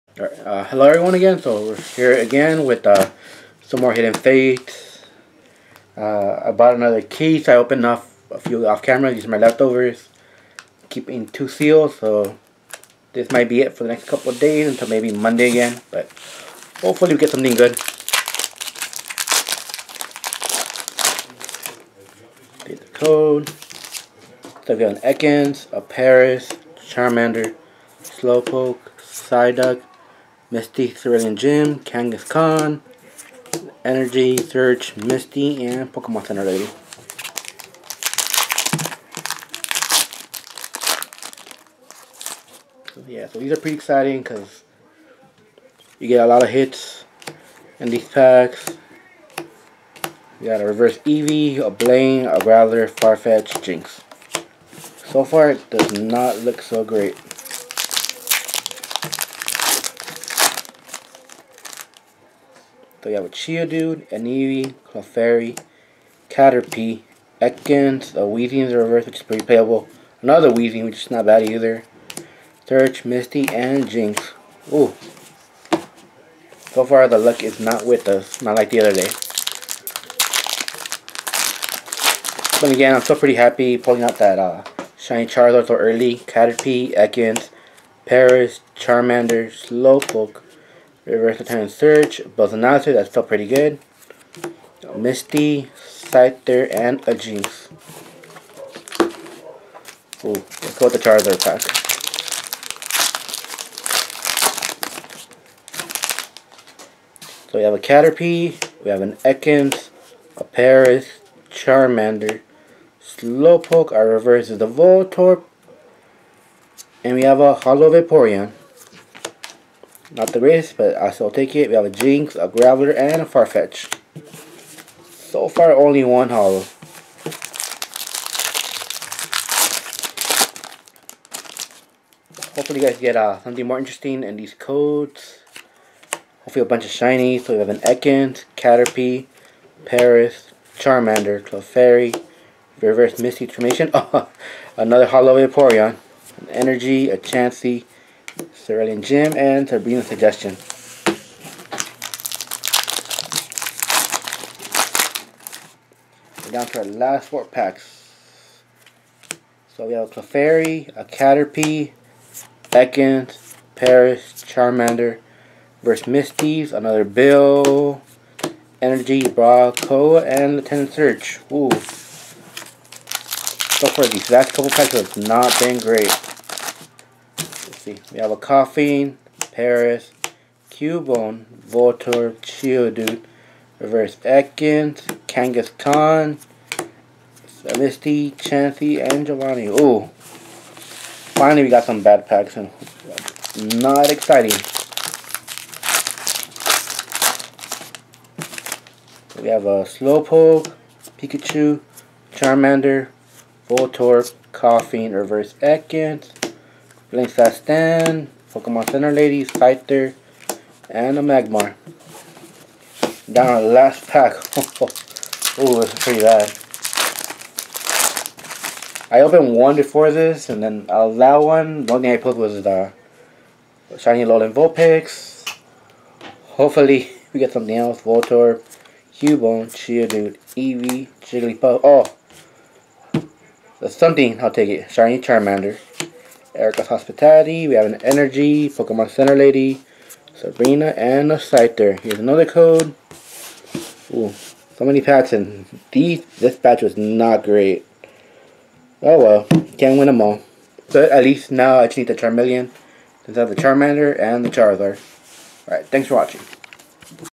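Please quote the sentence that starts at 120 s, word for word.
Not the greatest, but I still take it.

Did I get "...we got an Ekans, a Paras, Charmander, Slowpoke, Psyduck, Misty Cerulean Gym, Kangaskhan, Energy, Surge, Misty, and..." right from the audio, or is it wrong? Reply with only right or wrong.
right.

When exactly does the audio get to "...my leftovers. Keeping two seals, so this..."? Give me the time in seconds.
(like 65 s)
9 s.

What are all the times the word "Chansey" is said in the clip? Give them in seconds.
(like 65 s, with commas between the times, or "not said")
147 s, 188 s.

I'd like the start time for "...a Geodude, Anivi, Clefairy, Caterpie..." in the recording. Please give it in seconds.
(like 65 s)
63 s.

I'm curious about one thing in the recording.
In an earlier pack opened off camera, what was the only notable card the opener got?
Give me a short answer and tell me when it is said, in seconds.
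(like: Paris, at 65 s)
Shiny Alolan Vulpix, at 223 s.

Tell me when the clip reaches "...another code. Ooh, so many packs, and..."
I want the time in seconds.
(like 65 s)
242 s.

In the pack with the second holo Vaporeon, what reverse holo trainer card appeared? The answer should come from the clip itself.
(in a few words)
Misty Transformation.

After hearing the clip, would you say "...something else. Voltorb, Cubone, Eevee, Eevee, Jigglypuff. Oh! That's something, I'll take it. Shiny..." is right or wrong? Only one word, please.
wrong.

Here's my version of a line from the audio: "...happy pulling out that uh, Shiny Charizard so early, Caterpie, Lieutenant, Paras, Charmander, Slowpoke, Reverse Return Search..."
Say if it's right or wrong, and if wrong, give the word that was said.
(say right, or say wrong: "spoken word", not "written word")
wrong: "Ekans", not "Lieutenant".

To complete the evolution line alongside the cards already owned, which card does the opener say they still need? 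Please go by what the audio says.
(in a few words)
Charmeleon.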